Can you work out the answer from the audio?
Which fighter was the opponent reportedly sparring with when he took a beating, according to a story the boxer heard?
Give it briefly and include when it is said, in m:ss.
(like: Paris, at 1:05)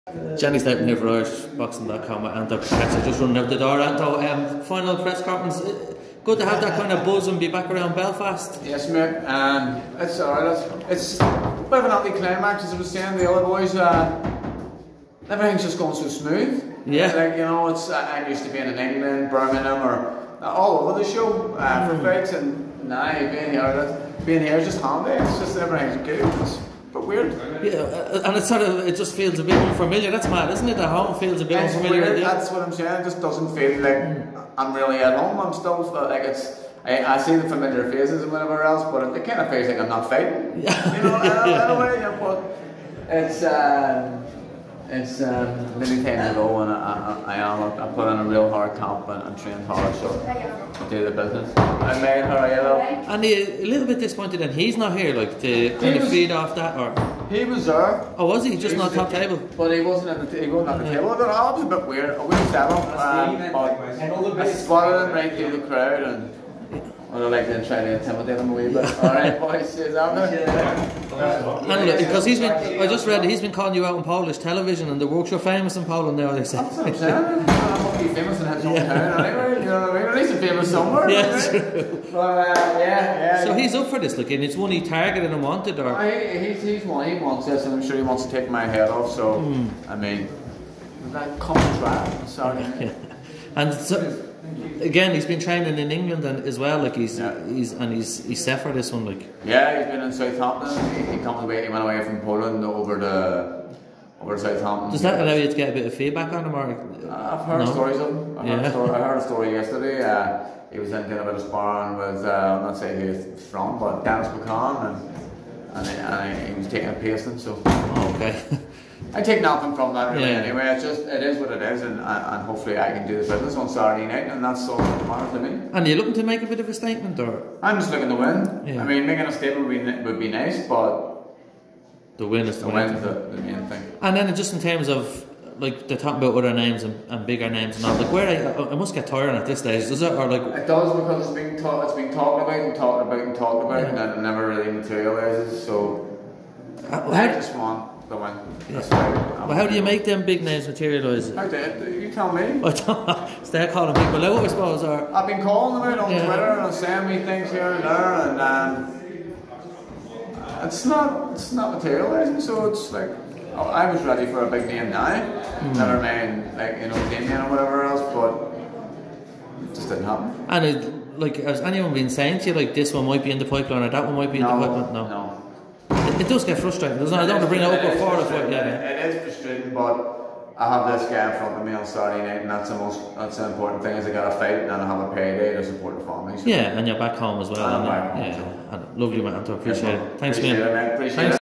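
Dennis McCann, at 1:54.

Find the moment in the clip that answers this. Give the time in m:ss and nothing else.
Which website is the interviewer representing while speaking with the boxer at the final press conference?
0:01.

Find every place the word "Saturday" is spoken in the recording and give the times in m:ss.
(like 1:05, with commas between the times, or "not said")
2:03, 3:01.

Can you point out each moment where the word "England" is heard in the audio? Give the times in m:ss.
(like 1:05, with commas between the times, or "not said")
0:18, 1:35.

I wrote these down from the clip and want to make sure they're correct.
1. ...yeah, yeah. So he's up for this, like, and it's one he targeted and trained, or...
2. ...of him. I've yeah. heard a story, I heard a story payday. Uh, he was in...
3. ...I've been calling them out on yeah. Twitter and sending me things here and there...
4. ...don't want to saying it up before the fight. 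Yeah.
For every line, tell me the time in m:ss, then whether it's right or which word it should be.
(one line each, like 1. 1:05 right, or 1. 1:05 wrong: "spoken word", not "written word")
1. 1:22 wrong: "wanted", not "trained"
2. 1:47 wrong: "yesterday", not "payday"
3. 2:35 right
4. 2:57 wrong: "bring", not "saying".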